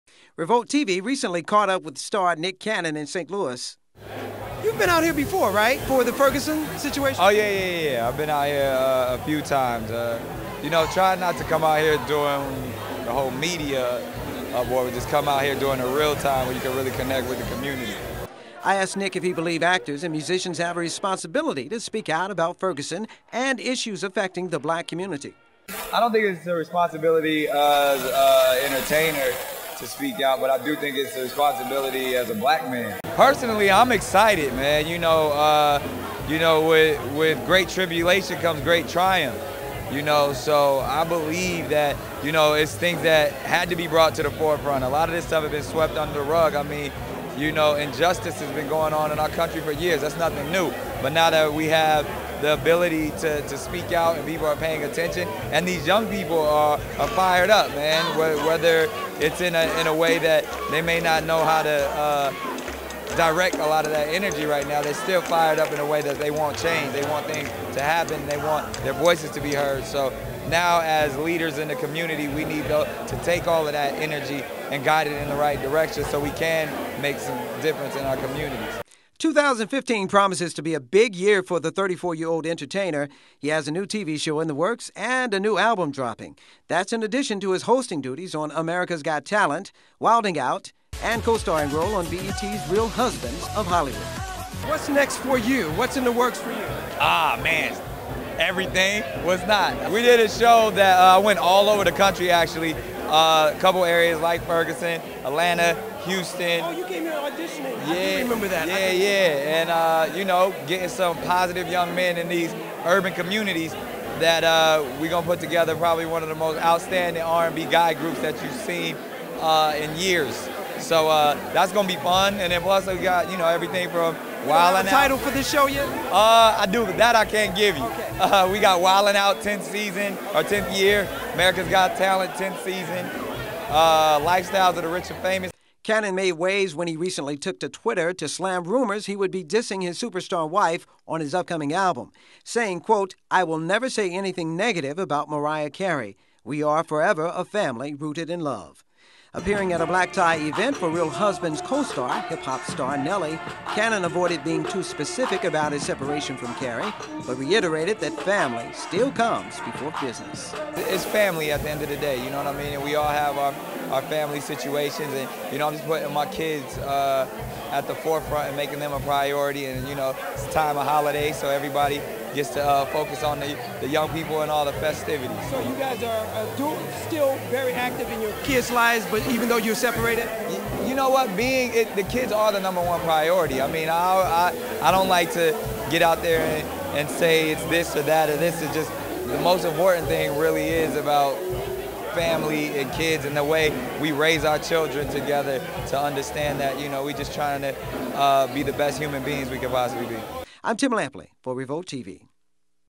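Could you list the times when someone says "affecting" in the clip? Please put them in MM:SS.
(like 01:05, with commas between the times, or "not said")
00:24.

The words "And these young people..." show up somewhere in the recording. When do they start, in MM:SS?
00:55.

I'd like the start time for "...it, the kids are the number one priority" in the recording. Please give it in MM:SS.
03:01.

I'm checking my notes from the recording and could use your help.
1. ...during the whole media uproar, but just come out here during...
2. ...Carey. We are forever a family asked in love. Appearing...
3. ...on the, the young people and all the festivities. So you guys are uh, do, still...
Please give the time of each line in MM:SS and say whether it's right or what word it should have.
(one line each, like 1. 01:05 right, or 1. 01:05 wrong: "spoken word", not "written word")
1. 00:12 right
2. 02:25 wrong: "rooted", not "asked"
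3. 02:53 right.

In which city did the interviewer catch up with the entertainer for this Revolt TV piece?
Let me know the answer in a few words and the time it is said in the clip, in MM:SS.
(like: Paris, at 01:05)
St. Louis, at 00:03.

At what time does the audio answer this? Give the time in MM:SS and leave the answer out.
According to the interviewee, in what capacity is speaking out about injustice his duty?
00:32.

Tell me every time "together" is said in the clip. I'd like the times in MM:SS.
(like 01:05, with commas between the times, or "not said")
01:55, 03:15.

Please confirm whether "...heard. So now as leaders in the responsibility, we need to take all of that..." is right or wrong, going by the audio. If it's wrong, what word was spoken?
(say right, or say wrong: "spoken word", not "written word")
wrong: "community", not "responsibility".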